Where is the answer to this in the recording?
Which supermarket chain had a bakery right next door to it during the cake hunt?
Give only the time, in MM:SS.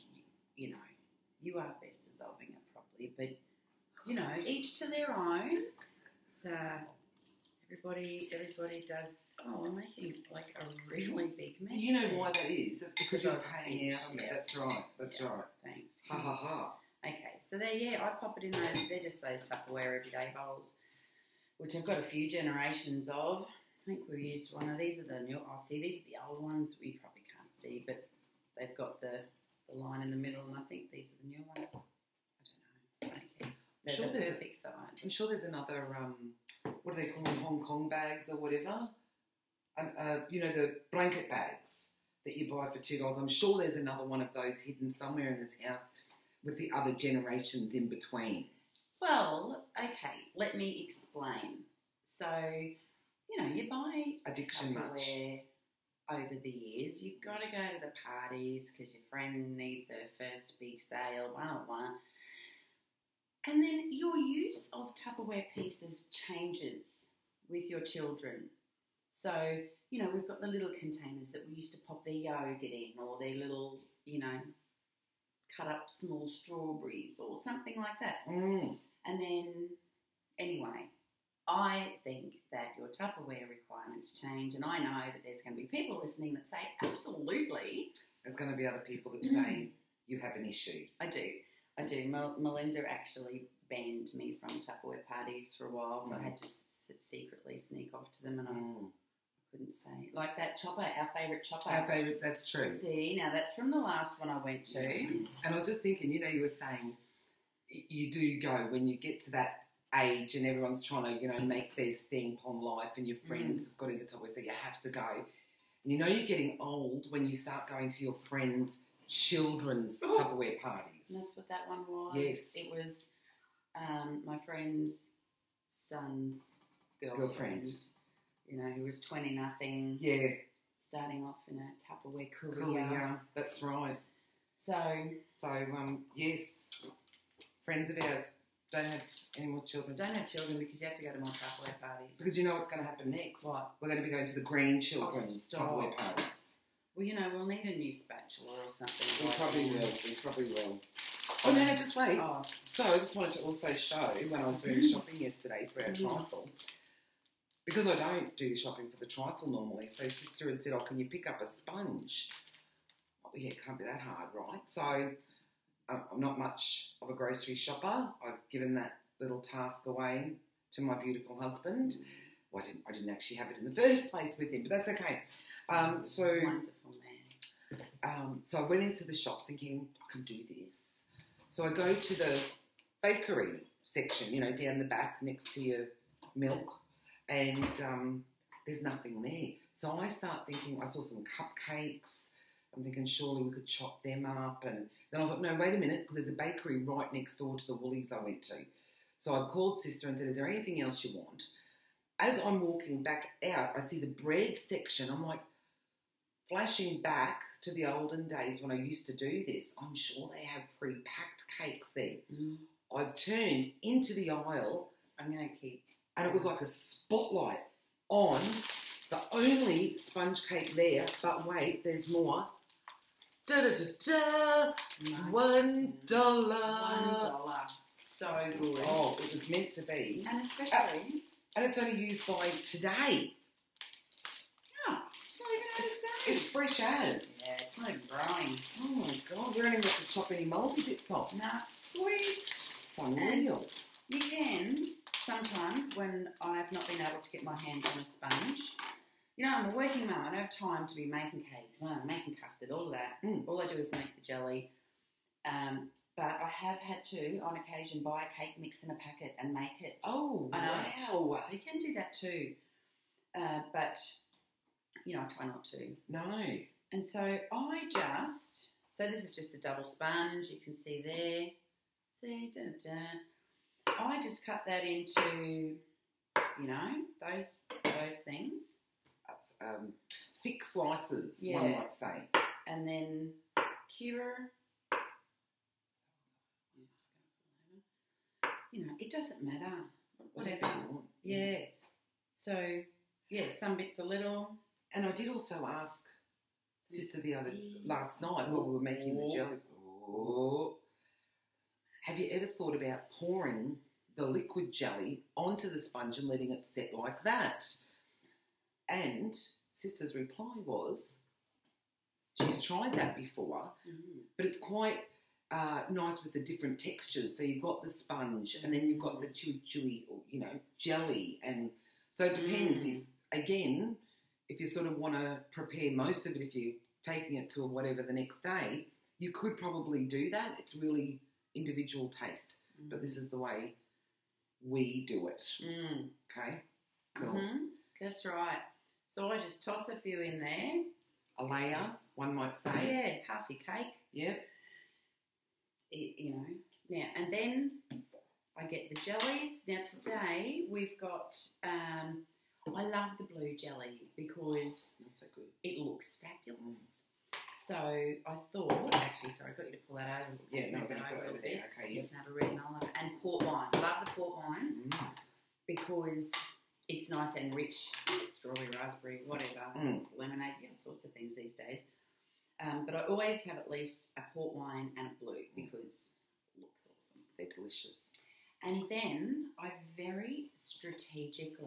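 03:17.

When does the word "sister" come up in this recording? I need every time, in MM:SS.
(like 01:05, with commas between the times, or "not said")
02:40, 03:19, 04:56, 05:09.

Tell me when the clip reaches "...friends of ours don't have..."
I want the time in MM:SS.
02:17.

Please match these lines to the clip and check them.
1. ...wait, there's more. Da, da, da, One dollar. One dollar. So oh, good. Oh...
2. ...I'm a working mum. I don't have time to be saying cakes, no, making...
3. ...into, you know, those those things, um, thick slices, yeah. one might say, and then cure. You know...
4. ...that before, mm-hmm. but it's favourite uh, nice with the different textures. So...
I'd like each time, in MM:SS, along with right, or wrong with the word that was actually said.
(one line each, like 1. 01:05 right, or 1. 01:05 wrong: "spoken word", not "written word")
1. 03:41 right
2. 04:09 wrong: "making", not "saying"
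3. 04:34 right
4. 05:12 wrong: "quite", not "favourite".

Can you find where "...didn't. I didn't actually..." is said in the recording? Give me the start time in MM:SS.
02:52.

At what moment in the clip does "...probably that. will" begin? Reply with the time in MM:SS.
02:29.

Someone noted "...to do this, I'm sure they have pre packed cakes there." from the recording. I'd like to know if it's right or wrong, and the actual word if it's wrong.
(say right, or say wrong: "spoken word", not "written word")
right.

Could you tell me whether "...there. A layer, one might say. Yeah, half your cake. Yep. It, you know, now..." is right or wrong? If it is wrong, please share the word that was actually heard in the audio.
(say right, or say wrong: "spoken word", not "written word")
right.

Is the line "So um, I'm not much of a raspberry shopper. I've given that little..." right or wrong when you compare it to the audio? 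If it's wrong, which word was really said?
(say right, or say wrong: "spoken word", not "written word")
wrong: "grocery", not "raspberry".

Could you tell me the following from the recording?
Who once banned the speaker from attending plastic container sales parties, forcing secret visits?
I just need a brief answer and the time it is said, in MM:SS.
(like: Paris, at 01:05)
Melinda, at 01:32.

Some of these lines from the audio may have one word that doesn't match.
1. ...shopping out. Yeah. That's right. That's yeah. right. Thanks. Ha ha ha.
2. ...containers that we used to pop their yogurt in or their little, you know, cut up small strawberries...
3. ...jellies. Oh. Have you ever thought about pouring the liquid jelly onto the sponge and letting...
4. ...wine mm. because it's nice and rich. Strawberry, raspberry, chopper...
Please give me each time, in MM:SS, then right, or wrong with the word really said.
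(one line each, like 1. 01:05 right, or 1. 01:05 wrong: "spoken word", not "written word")
1. 00:13 wrong: "paying", not "shopping"
2. 01:10 right
3. 04:59 right
4. 06:04 wrong: "whatever", not "chopper".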